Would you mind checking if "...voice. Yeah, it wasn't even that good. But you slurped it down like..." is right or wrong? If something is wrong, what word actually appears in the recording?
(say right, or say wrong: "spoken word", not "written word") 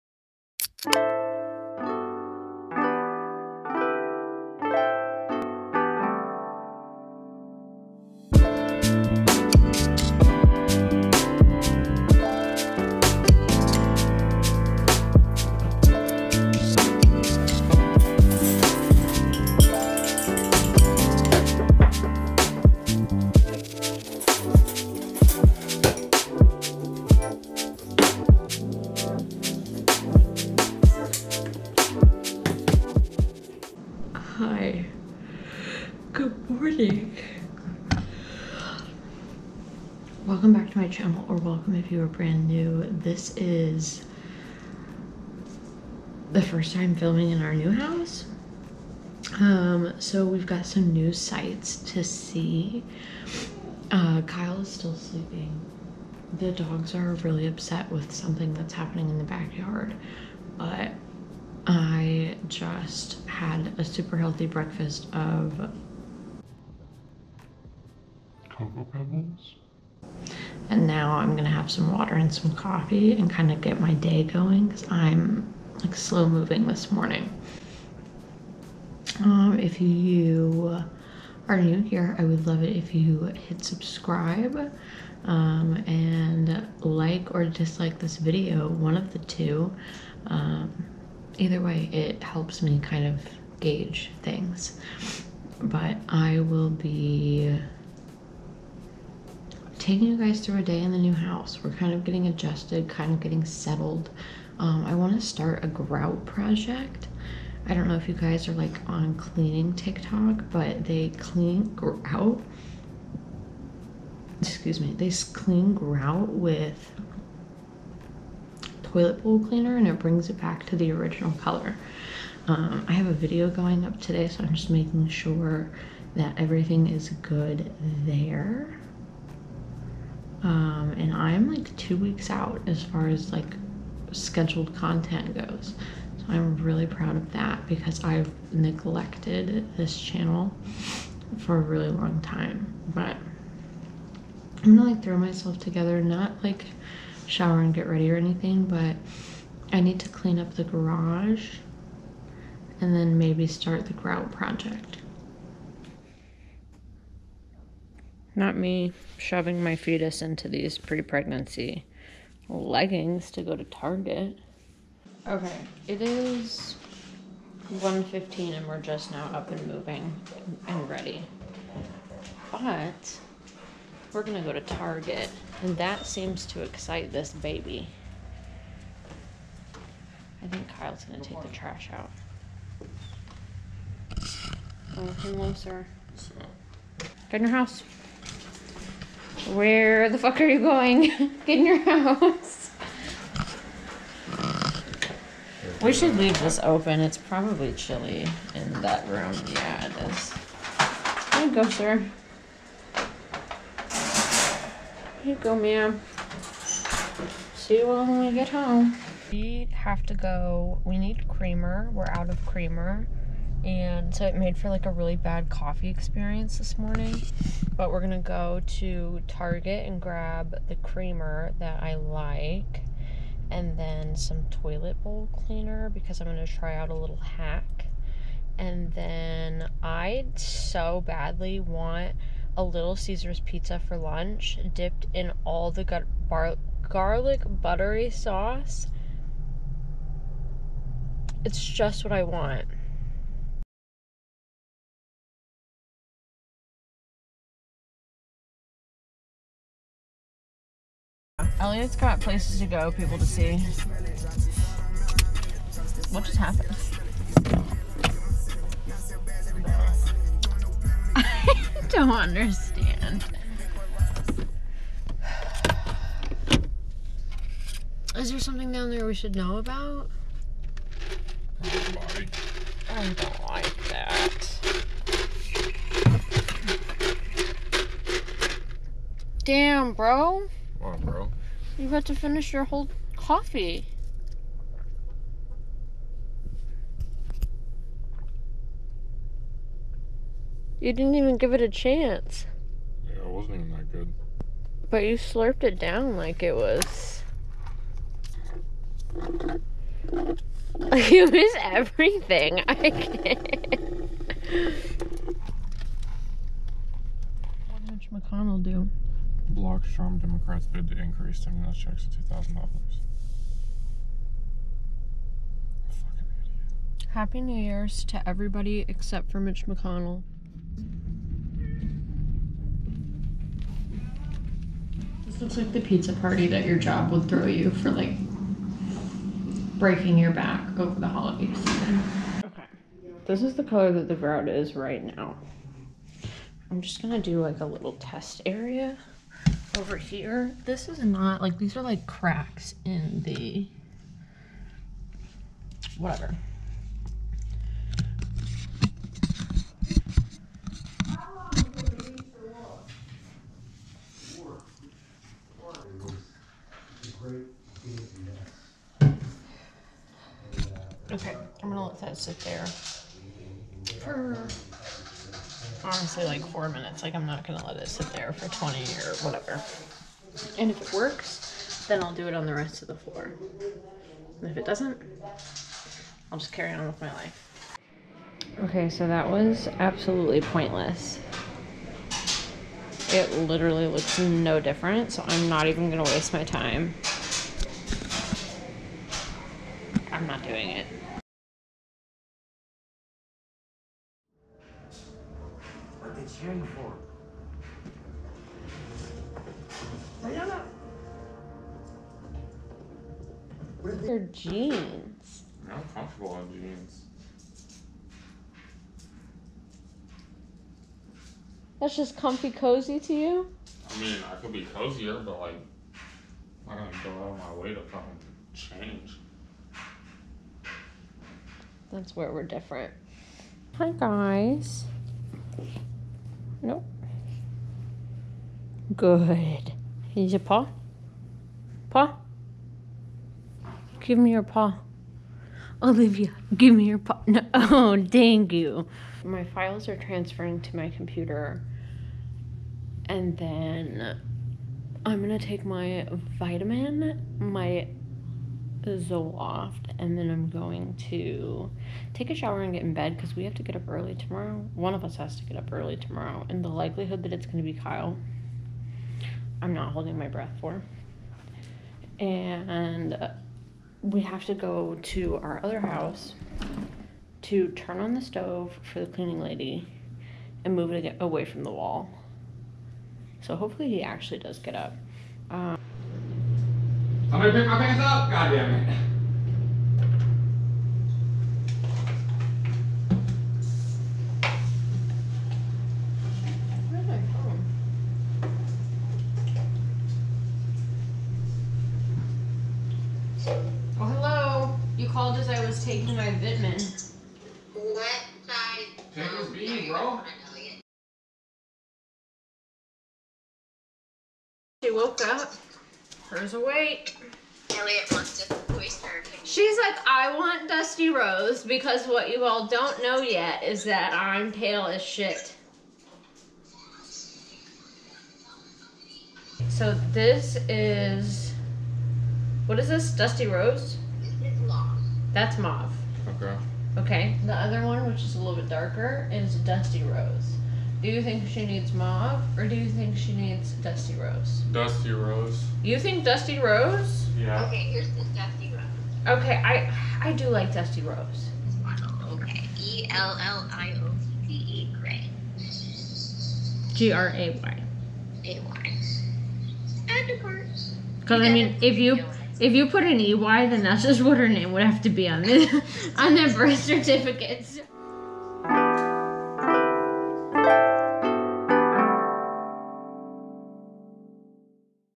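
wrong: "chance", not "voice".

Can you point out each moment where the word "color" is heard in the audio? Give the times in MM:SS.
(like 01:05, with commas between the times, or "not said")
02:01, 05:33.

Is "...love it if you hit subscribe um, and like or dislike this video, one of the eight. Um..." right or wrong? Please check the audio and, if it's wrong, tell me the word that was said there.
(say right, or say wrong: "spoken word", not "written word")
wrong: "two", not "eight".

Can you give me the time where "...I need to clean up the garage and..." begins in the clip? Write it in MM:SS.
02:29.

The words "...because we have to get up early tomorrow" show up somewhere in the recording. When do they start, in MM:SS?
07:33.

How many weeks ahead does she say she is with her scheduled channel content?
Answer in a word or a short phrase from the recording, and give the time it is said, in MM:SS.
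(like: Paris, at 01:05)
2, at 02:11.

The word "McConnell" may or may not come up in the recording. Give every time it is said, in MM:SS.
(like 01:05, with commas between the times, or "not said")
05:08, 05:19.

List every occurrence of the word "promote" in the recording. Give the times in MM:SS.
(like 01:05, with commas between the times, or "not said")
not said.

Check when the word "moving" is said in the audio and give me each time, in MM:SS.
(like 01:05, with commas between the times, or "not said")
01:16, 02:49.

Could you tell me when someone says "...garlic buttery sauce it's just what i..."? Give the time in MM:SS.
03:56.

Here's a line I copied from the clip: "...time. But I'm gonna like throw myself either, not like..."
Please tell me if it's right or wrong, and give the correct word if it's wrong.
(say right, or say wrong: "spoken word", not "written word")
wrong: "together", not "either".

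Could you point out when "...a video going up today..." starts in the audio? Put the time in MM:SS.
02:03.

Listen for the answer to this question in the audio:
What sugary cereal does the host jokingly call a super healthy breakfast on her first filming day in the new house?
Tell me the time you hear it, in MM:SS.
01:08.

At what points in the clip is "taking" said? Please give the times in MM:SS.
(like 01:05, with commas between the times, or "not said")
01:39, 08:15.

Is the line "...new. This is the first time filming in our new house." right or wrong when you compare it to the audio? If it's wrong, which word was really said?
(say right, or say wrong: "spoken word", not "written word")
right.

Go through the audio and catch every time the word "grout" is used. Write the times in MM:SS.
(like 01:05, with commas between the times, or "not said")
01:45, 01:51, 01:55, 02:33, 05:34.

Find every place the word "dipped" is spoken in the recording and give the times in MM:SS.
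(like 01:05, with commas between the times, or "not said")
03:54.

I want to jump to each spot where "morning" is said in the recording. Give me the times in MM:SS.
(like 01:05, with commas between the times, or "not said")
00:36, 01:16, 03:36.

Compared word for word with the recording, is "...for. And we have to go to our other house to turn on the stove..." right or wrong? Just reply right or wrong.
right.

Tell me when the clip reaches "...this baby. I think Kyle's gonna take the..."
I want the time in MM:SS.
02:57.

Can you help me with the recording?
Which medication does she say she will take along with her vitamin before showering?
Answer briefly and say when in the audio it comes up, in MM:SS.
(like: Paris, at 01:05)
Zoloft, at 07:28.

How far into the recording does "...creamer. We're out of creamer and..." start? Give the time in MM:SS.
03:31.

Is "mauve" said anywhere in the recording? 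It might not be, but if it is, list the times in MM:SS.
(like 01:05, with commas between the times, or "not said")
08:45, 08:51.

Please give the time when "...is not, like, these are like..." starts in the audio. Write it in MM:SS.
05:40.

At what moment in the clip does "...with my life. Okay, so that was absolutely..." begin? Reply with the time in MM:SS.
06:16.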